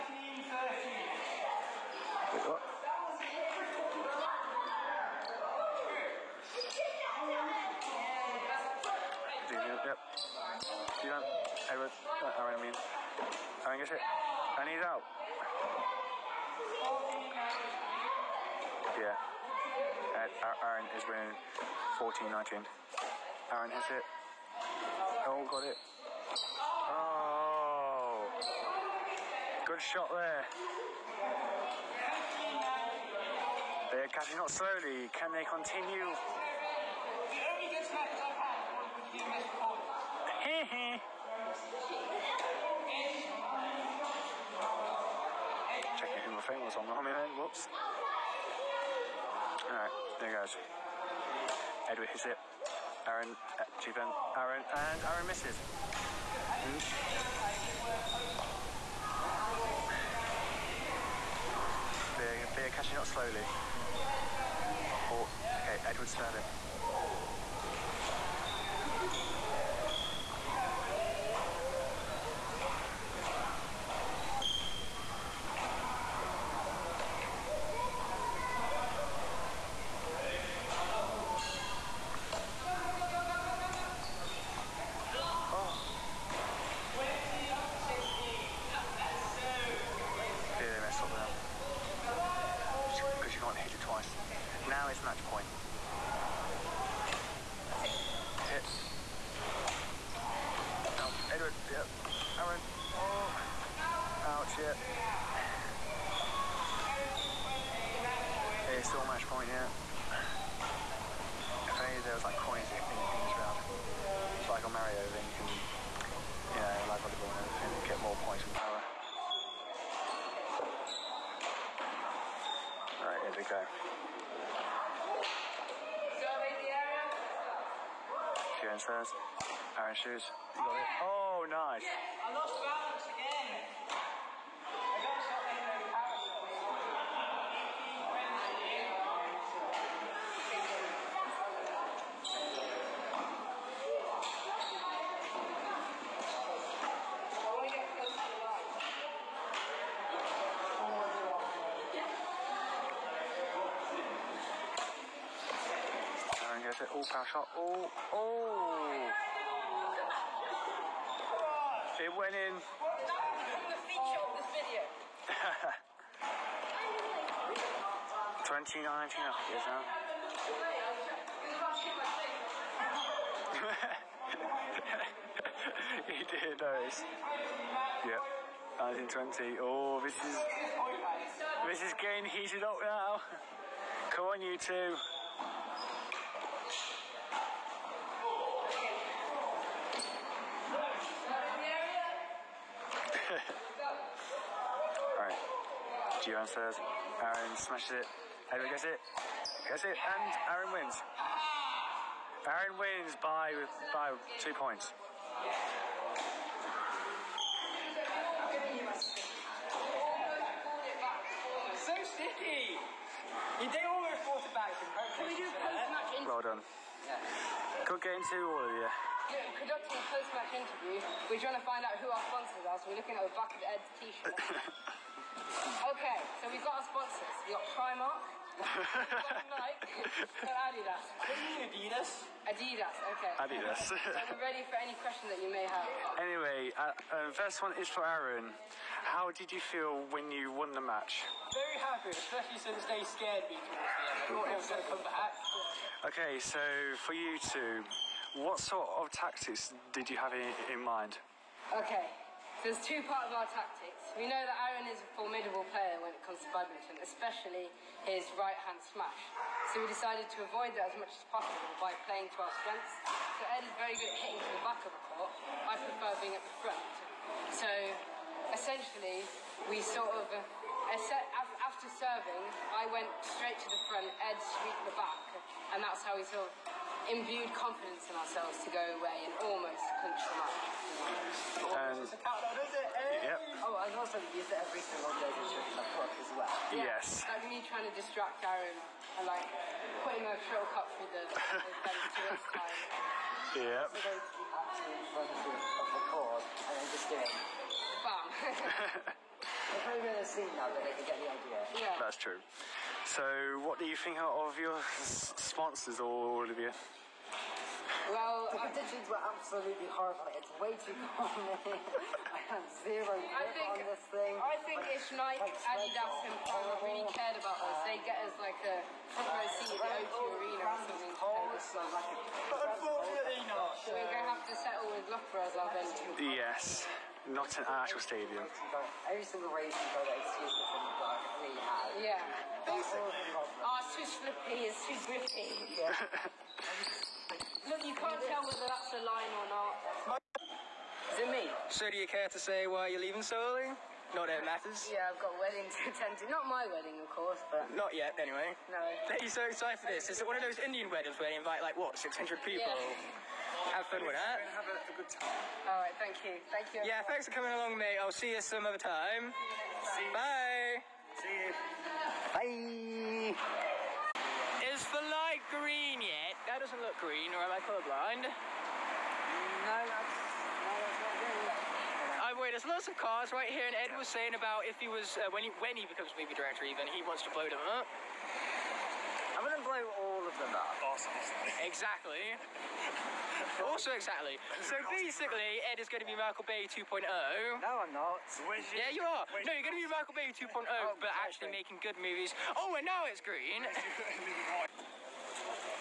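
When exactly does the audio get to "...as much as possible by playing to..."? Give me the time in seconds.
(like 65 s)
260 s.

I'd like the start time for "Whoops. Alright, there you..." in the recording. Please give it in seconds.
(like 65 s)
47 s.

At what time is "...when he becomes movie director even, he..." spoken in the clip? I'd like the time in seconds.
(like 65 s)
375 s.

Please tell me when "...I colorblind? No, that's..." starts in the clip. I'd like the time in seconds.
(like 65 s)
367 s.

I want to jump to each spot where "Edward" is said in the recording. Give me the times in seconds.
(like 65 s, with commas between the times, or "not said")
11 s, 51 s, 65 s, 101 s, 198 s.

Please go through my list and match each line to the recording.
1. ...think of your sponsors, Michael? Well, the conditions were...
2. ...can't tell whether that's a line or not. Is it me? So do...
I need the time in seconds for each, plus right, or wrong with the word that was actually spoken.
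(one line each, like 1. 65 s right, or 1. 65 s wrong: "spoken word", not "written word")
1. 303 s wrong: "Olivia", not "Michael"
2. 337 s right.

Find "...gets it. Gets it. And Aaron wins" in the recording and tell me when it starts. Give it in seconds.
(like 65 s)
198 s.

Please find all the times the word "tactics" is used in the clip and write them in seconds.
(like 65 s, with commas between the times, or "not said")
249 s, 253 s.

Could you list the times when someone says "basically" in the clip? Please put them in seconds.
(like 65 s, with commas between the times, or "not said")
332 s, 384 s.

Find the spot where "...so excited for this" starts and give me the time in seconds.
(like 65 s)
349 s.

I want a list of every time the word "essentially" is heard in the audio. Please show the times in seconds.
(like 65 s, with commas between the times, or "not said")
268 s.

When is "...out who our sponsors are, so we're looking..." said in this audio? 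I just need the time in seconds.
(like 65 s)
221 s.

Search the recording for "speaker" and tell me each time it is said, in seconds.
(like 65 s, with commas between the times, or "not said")
not said.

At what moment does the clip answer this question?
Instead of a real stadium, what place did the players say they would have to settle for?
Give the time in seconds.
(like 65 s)
325 s.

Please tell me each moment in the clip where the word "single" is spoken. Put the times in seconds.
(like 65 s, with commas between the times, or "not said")
284 s, 329 s.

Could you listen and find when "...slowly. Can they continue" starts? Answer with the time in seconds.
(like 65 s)
34 s.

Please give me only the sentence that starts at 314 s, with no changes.
I think but if Nike, Adidas, and Prada really oh.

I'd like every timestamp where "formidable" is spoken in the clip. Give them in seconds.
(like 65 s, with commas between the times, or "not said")
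255 s.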